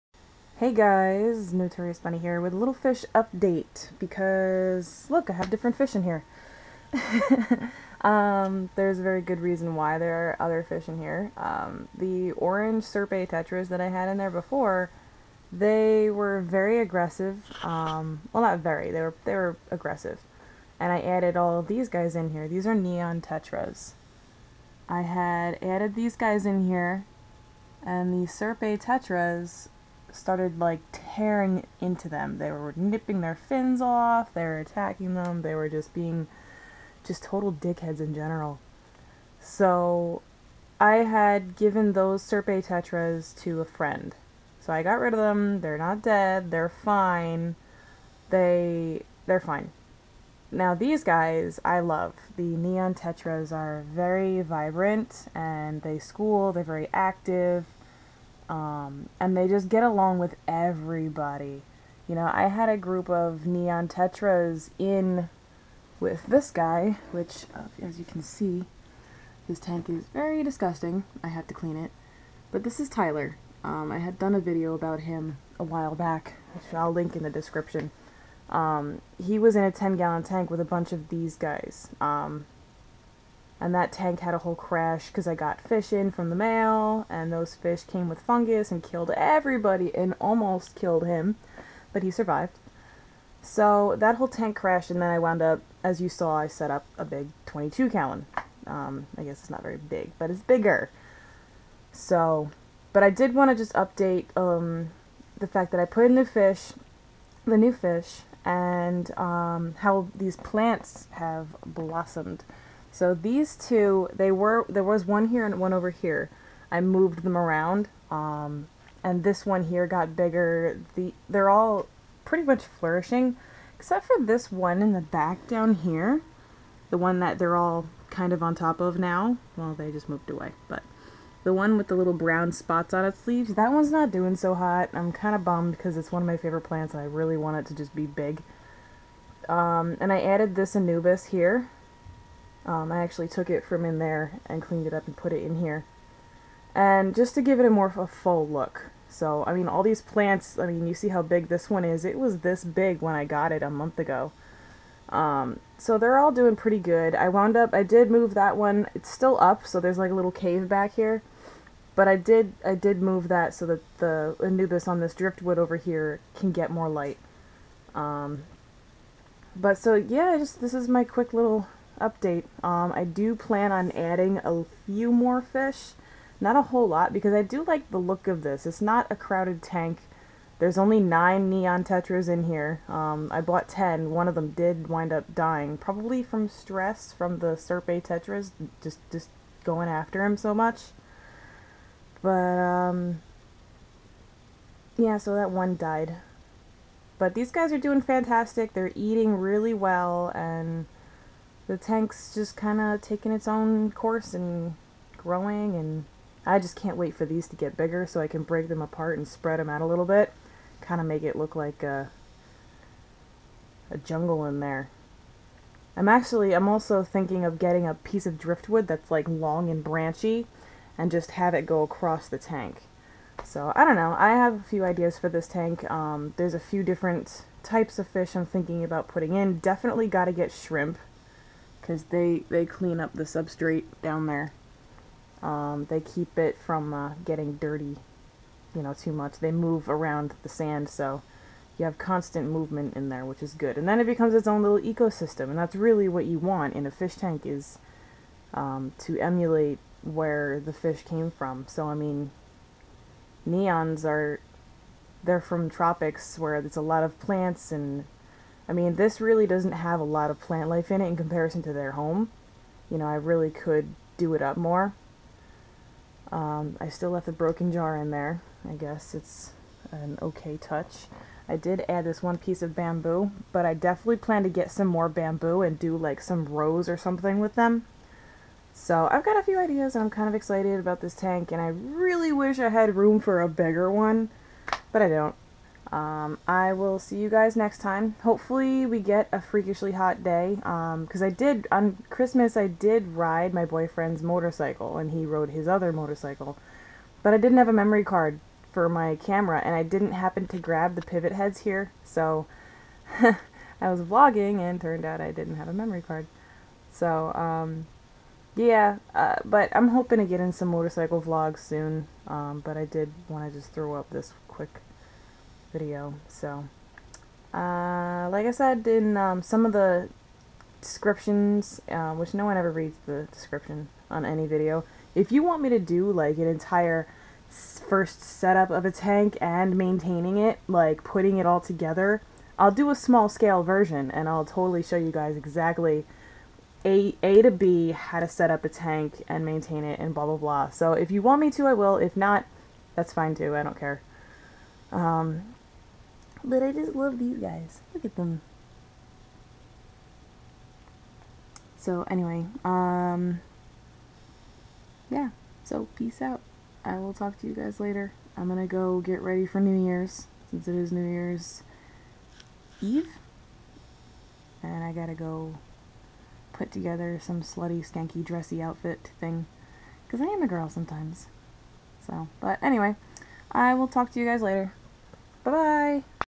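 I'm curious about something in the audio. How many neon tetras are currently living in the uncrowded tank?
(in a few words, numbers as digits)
9.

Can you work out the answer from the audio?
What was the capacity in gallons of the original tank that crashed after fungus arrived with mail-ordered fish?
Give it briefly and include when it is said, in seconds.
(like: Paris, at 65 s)
10 gallons, at 79 s.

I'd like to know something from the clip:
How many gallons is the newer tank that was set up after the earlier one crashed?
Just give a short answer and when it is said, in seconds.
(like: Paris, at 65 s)
22 gallons, at 97 s.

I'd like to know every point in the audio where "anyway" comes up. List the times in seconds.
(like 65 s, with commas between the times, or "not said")
352 s, 372 s.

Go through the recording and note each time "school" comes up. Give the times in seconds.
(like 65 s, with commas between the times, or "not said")
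55 s.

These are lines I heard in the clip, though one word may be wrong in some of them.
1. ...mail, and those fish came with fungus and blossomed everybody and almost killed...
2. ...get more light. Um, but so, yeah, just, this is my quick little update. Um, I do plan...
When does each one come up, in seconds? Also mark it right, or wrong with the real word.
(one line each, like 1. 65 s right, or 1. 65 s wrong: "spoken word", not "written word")
1. 86 s wrong: "killed", not "blossomed"
2. 166 s right.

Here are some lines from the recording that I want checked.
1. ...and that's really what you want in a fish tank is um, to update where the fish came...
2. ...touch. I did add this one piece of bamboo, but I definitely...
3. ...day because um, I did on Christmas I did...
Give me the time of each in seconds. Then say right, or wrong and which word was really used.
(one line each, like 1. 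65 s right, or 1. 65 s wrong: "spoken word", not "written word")
1. 245 s wrong: "emulate", not "update"
2. 270 s right
3. 290 s right.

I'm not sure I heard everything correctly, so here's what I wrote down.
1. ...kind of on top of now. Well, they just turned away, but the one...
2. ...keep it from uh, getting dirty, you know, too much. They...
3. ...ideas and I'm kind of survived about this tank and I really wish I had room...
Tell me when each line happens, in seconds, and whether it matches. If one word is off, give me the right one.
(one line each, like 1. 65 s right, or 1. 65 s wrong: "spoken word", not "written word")
1. 128 s wrong: "moved", not "turned"
2. 235 s right
3. 279 s wrong: "excited", not "survived".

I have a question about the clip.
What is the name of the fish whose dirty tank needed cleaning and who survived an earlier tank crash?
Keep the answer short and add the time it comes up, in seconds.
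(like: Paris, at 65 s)
Tyler, at 72 s.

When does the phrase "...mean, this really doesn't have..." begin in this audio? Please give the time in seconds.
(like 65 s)
258 s.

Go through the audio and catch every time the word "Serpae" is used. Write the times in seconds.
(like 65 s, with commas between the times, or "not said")
12 s, 28 s, 42 s, 187 s.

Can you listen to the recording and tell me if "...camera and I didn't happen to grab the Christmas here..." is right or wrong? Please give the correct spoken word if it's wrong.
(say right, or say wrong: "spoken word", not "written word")
wrong: "Pivotheads", not "Christmas".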